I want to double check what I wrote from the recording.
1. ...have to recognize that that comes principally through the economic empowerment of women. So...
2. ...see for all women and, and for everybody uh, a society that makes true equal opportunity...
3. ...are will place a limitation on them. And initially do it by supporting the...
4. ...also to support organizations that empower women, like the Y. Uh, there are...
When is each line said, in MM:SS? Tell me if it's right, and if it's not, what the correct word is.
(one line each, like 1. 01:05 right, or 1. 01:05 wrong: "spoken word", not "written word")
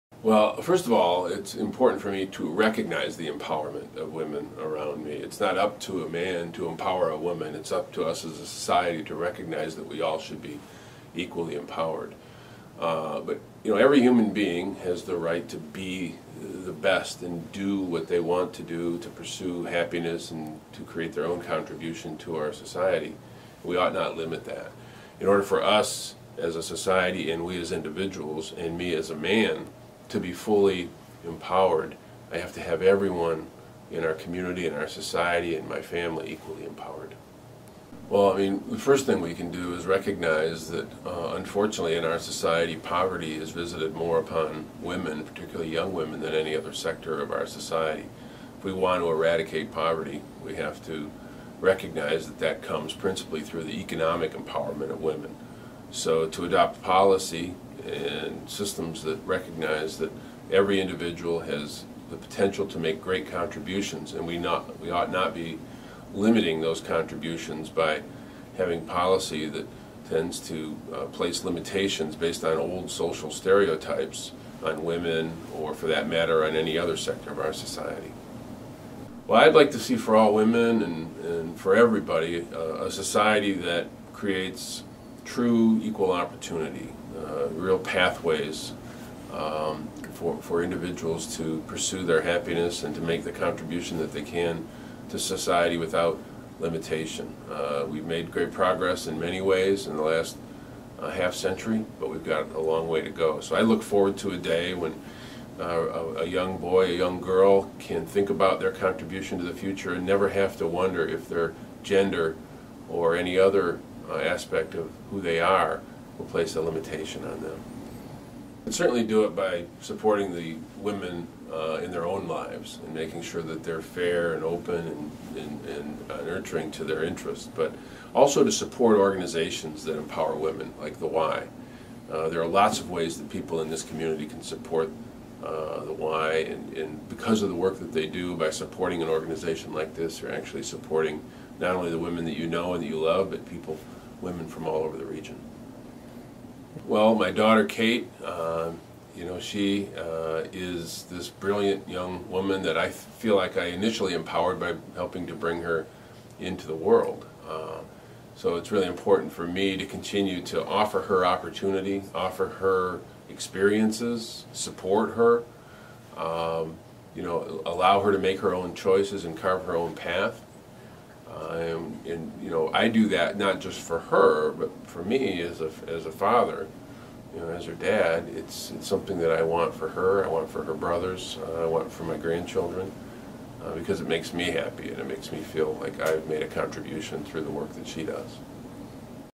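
1. 00:50 right
2. 01:19 wrong: "creates", not "makes"
3. 01:55 wrong: "certainly", not "initially"
4. 02:08 right.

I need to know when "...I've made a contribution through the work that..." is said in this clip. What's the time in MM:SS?
03:06.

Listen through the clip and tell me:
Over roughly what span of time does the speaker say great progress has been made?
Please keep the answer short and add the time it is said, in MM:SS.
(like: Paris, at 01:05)
half century, at 01:41.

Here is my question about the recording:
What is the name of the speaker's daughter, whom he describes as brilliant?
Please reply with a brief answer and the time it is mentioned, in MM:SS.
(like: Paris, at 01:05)
Kate, at 02:27.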